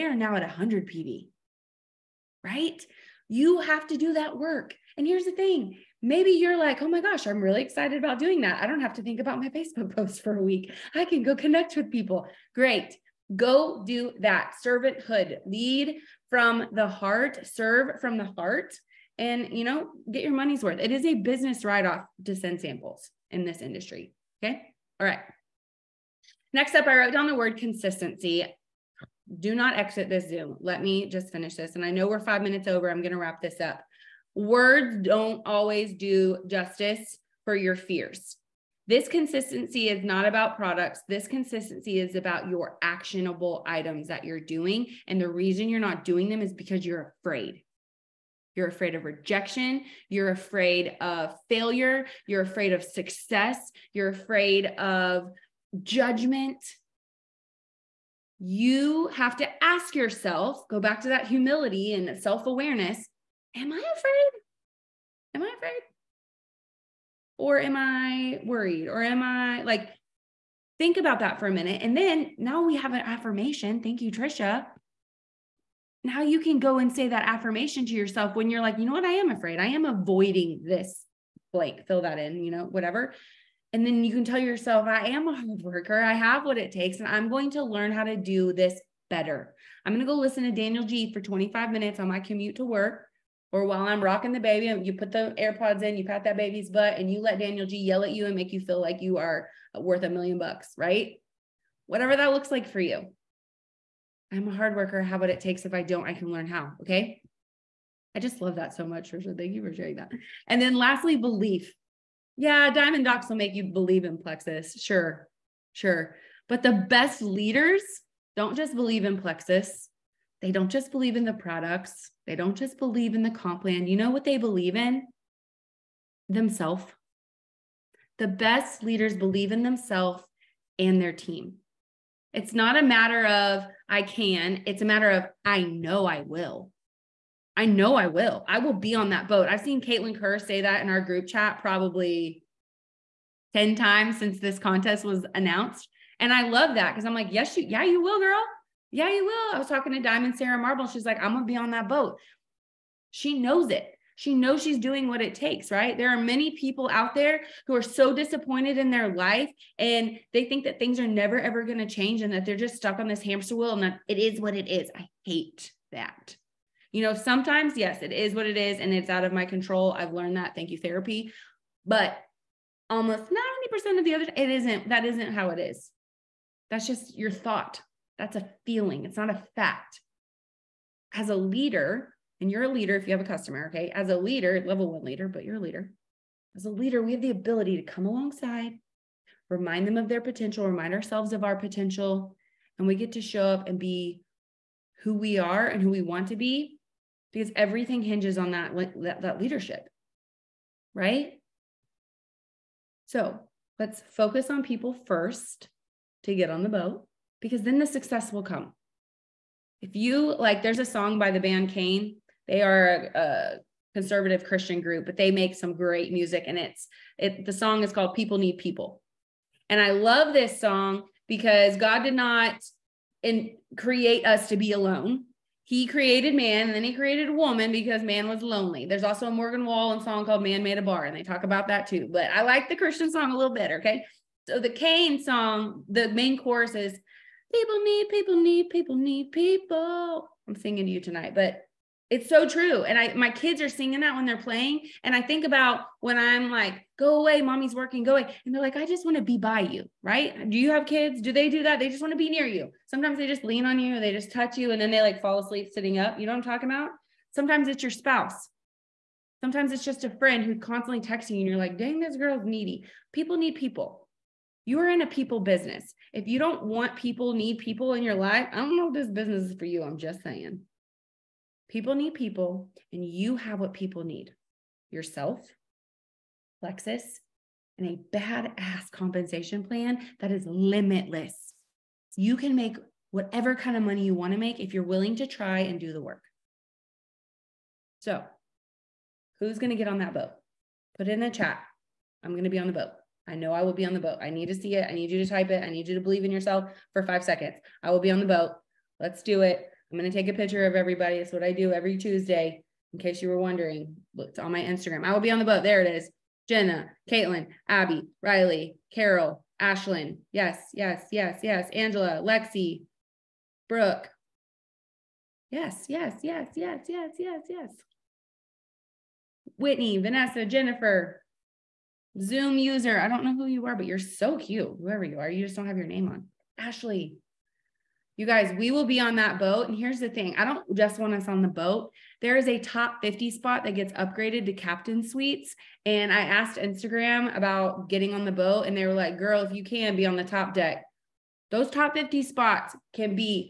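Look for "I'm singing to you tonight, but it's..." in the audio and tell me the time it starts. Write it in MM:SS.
04:00.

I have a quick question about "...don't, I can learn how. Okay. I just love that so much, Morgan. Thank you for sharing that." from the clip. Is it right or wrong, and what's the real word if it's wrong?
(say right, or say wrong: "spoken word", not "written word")
wrong: "Tricia", not "Morgan".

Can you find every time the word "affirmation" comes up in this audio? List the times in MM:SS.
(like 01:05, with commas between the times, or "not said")
01:13, 01:17.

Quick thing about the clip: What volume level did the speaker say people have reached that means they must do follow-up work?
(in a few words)
100 PV.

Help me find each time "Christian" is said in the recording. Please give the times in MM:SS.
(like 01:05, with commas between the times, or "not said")
03:34, 03:52.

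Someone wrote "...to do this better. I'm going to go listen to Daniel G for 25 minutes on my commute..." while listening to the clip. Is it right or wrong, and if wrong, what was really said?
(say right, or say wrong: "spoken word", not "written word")
right.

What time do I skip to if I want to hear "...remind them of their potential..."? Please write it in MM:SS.
03:09.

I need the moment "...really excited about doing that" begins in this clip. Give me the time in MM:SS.
00:07.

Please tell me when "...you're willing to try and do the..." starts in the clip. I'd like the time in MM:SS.
04:44.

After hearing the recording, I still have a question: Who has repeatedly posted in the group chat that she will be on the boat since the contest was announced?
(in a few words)
Caitlin Kerr.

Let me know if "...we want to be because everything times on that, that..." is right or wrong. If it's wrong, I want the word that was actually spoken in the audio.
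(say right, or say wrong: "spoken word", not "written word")
wrong: "hinges", not "times".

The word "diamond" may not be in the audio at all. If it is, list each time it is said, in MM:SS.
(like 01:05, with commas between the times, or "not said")
01:52, 02:30.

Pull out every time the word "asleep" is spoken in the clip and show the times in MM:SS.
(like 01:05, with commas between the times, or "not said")
04:15.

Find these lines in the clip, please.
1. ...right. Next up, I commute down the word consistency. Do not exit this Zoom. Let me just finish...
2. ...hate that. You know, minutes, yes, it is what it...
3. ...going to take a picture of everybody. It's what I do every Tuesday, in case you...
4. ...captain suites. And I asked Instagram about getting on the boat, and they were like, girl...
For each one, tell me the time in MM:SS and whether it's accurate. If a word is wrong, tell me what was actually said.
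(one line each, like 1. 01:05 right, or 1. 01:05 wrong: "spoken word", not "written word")
1. 00:25 wrong: "wrote", not "commute"
2. 02:45 wrong: "sometimes", not "minutes"
3. 04:59 right
4. 05:34 right.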